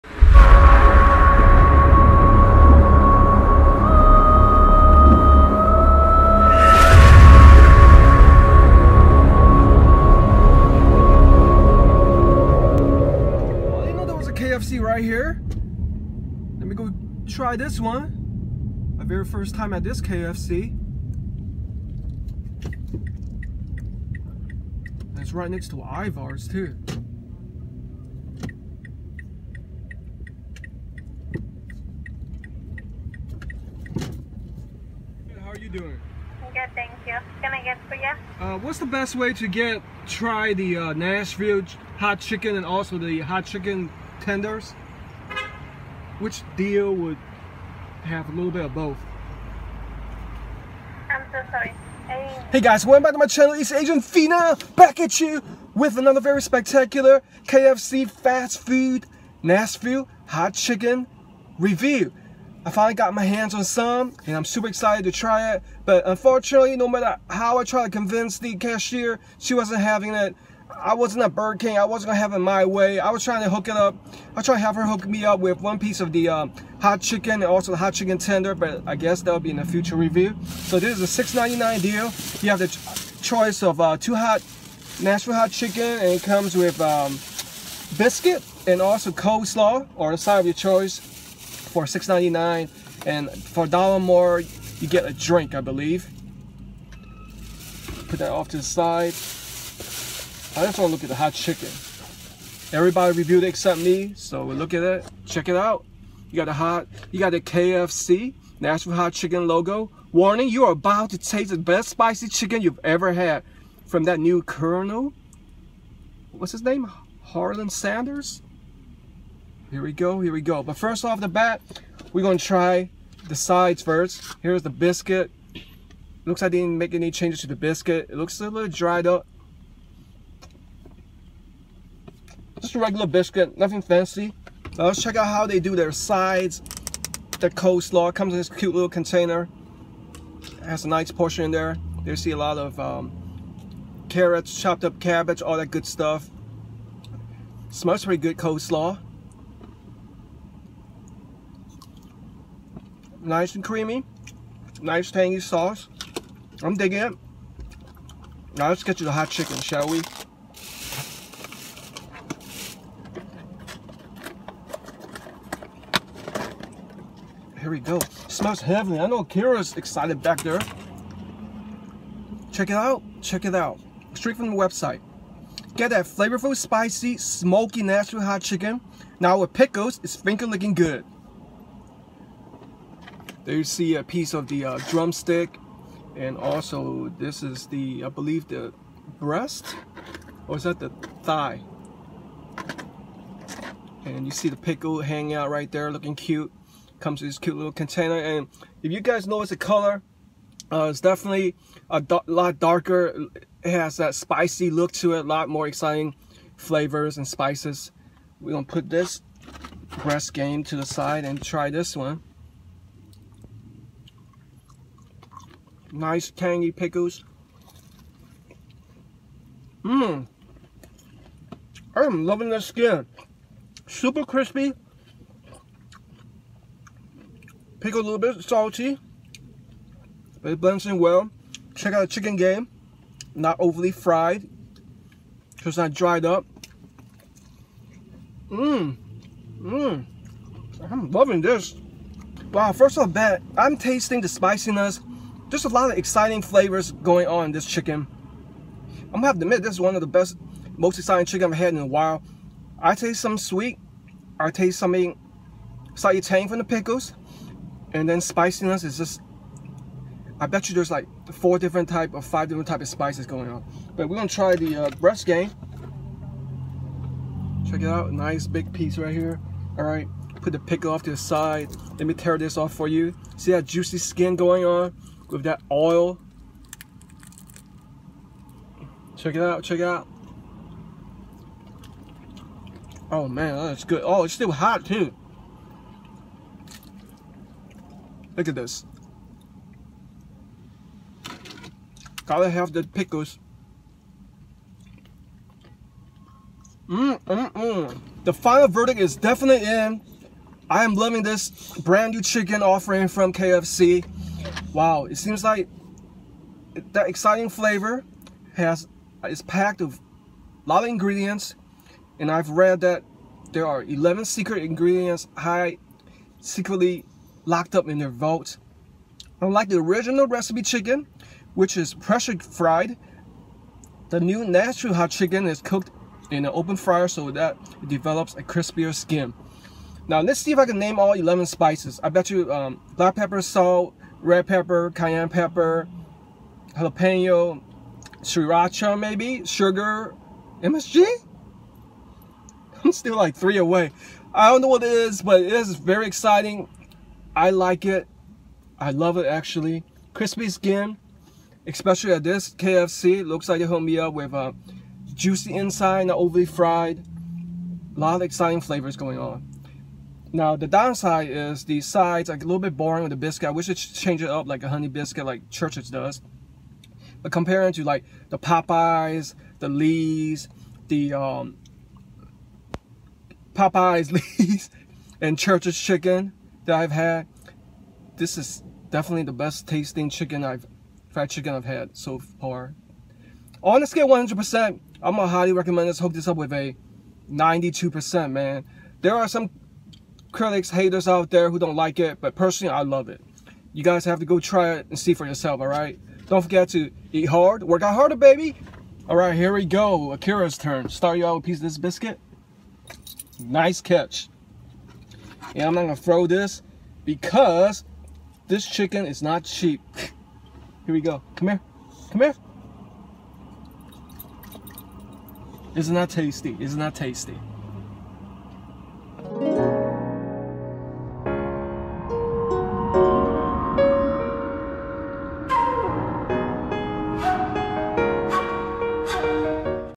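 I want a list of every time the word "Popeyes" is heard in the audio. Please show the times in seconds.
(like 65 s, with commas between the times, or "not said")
368 s, 373 s.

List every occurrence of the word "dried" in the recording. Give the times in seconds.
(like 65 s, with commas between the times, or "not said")
128 s, 235 s.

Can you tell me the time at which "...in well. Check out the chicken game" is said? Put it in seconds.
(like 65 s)
230 s.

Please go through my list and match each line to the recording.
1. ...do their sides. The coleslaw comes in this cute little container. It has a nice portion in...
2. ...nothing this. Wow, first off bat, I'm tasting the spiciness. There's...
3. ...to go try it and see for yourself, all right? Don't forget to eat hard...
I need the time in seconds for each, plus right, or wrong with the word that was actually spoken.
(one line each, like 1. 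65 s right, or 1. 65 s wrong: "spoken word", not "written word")
1. 135 s right
2. 241 s wrong: "loving", not "nothing"
3. 394 s right.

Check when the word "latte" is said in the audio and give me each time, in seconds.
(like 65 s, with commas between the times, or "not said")
not said.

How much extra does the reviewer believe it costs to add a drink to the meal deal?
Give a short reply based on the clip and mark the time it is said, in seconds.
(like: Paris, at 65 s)
A dollar, at 93 s.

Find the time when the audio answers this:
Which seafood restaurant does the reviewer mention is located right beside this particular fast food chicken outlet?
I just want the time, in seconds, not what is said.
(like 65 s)
25 s.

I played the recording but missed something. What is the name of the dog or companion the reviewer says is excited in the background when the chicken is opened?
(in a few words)
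Kira.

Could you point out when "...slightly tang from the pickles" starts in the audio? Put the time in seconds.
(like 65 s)
255 s.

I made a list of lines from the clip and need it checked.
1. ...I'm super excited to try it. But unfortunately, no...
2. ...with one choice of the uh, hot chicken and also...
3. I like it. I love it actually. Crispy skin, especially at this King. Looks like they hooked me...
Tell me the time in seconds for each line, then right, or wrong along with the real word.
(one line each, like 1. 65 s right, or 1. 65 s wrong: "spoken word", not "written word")
1. 64 s right
2. 75 s wrong: "piece", not "choice"
3. 347 s wrong: "KFC", not "King".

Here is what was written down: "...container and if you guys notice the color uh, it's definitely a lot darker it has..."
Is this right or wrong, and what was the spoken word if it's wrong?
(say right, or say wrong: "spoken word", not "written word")
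right.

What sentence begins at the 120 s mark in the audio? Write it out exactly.
But first off the bat, we're gonna try the sides first.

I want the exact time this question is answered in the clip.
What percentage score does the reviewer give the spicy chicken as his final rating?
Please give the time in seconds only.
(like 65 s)
387 s.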